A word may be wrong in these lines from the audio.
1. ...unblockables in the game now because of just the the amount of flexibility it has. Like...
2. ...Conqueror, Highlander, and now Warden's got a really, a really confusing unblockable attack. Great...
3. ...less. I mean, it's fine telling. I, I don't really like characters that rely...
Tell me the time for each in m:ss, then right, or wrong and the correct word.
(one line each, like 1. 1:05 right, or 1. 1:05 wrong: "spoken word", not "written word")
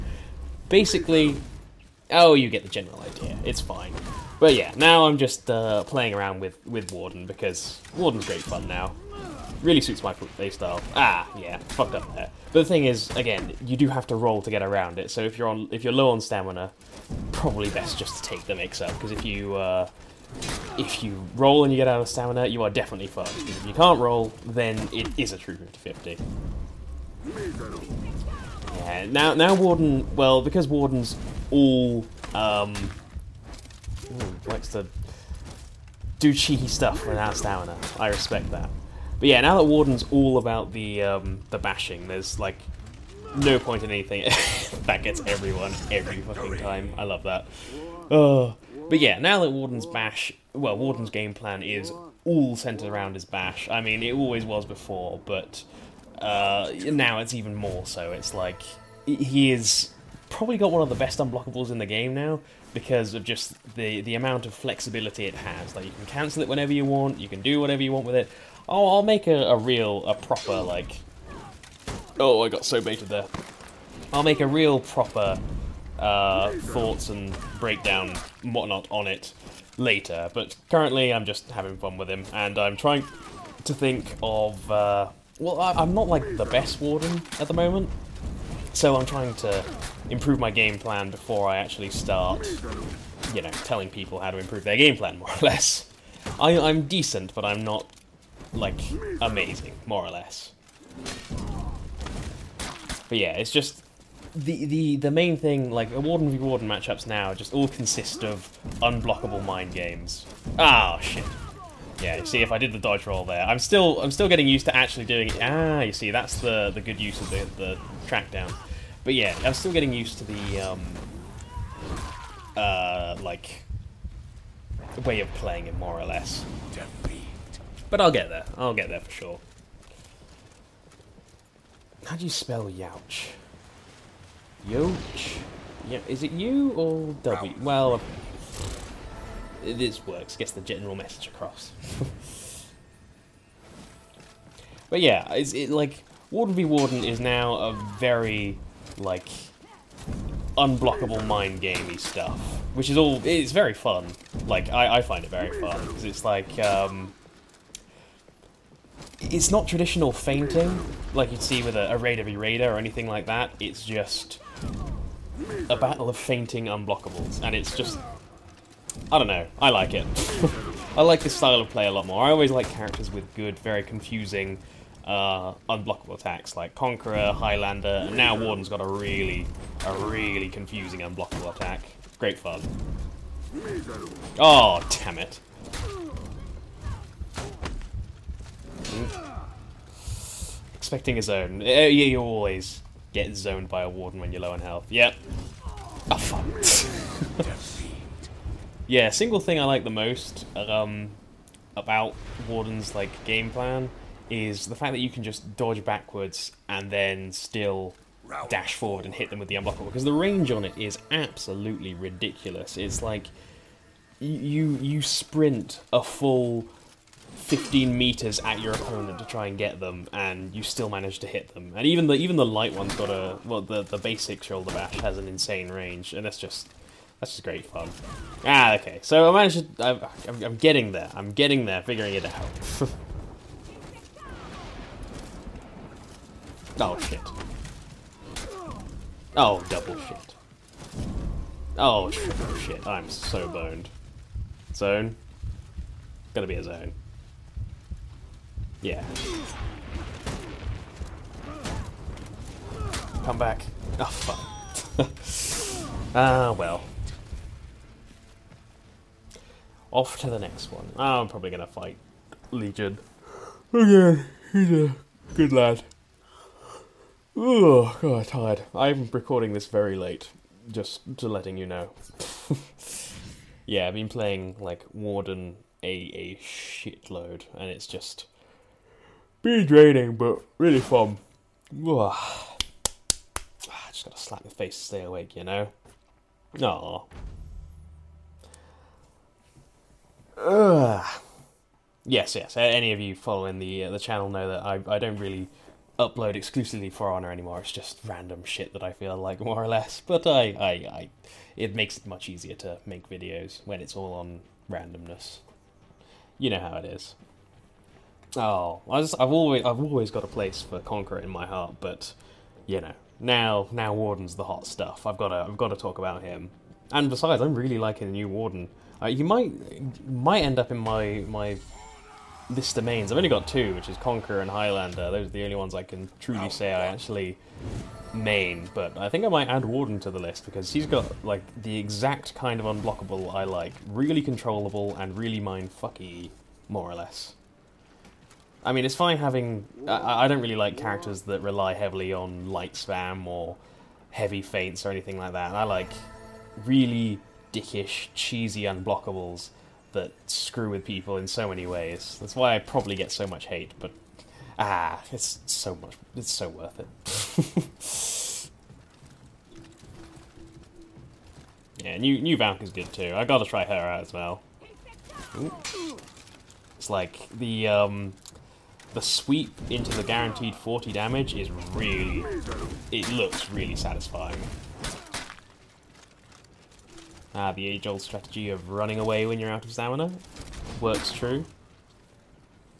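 1. 1:01 right
2. 2:56 right
3. 5:36 wrong: "having", not "telling".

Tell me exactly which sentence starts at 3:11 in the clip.
Uh, yeah, you always get zoned by a warden when you're low on health.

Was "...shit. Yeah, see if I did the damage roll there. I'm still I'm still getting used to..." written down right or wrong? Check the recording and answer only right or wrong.
wrong.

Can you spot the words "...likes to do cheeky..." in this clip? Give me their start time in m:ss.
0:34.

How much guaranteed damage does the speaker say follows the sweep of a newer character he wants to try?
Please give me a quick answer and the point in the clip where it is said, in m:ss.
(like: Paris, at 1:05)
40, at 6:10.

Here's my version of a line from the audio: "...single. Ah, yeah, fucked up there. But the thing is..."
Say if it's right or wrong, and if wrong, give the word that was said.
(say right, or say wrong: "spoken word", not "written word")
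wrong: "playstyle", not "single".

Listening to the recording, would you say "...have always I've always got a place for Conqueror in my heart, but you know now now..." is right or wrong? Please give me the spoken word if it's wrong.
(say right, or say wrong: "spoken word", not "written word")
right.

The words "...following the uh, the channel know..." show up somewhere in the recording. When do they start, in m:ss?
4:53.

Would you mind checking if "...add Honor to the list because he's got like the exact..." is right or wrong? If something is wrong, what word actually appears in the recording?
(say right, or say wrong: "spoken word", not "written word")
wrong: "Warden", not "Honor".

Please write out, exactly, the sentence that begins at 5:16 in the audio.
And besides, I'm really liking the new Warden.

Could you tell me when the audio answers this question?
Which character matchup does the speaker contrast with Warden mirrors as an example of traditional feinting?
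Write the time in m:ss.
2:41.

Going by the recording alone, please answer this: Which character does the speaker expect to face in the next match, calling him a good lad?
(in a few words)
Legion.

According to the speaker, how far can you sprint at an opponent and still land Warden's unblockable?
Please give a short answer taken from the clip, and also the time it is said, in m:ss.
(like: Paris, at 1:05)
15 meters, at 3:37.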